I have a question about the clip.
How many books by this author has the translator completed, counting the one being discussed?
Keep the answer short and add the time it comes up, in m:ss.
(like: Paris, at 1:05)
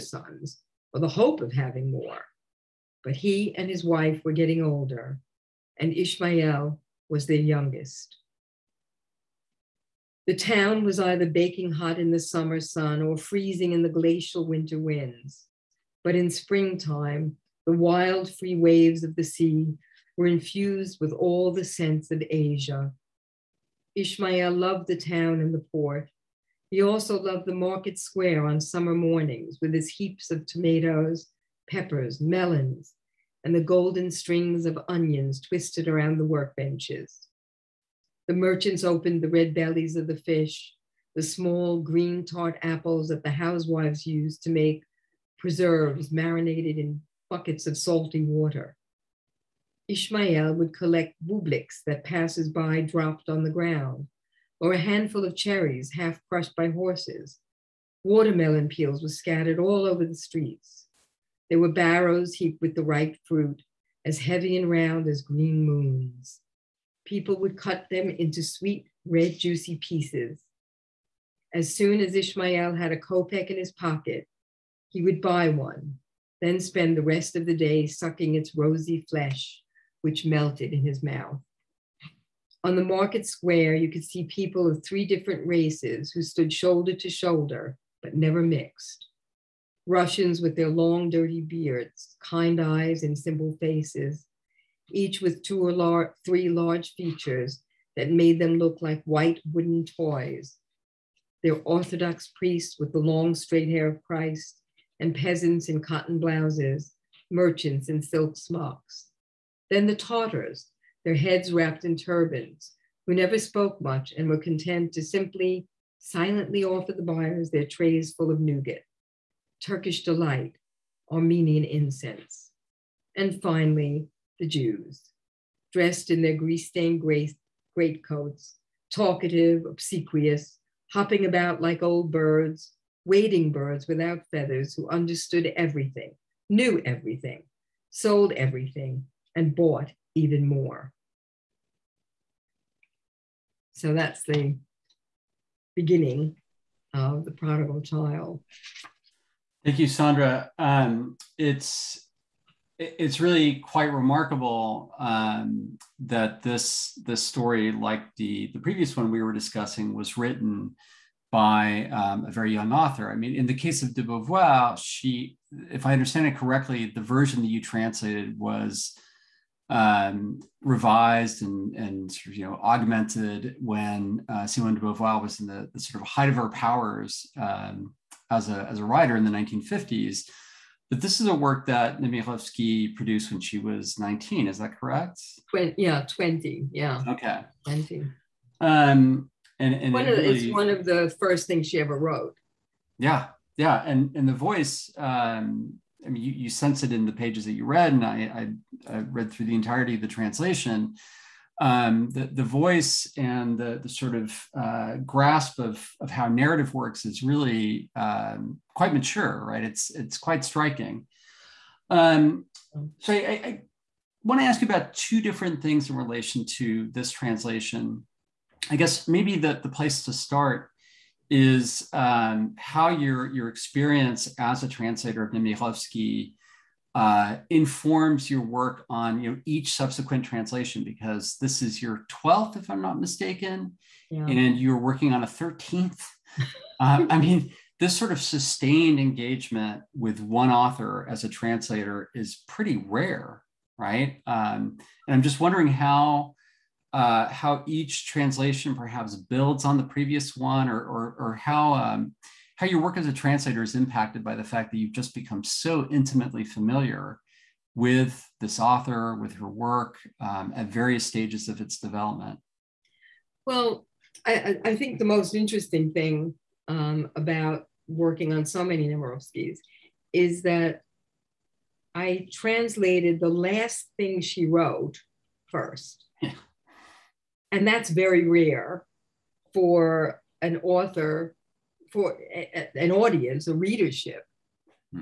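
12, at 3:52.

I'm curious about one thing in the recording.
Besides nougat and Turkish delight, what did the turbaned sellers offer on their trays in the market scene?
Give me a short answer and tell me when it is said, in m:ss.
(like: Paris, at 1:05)
Armenian incense, at 2:01.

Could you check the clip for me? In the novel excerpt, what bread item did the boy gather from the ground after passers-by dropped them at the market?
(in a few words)
bubliks.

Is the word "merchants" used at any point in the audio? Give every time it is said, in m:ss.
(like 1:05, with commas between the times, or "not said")
0:38, 1:47.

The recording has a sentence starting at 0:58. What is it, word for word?
Watermelon peels were scattered all over the streets.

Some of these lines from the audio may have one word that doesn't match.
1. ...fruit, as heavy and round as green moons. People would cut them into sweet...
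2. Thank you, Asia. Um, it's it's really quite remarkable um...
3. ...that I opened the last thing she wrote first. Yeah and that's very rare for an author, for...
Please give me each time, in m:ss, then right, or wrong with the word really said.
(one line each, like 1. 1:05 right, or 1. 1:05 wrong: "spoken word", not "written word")
1. 1:03 right
2. 2:29 wrong: "Sandra", not "Asia"
3. 4:30 wrong: "translated", not "opened".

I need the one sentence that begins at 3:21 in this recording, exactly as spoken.
Um, the, the voice and the, the sort of uh, grasp of, of how narrative works is really um, quite mature, right?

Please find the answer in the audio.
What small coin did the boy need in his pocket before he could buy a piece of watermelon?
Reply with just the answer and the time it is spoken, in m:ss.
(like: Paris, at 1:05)
kopeck, at 1:12.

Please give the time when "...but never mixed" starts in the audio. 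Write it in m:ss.
1:28.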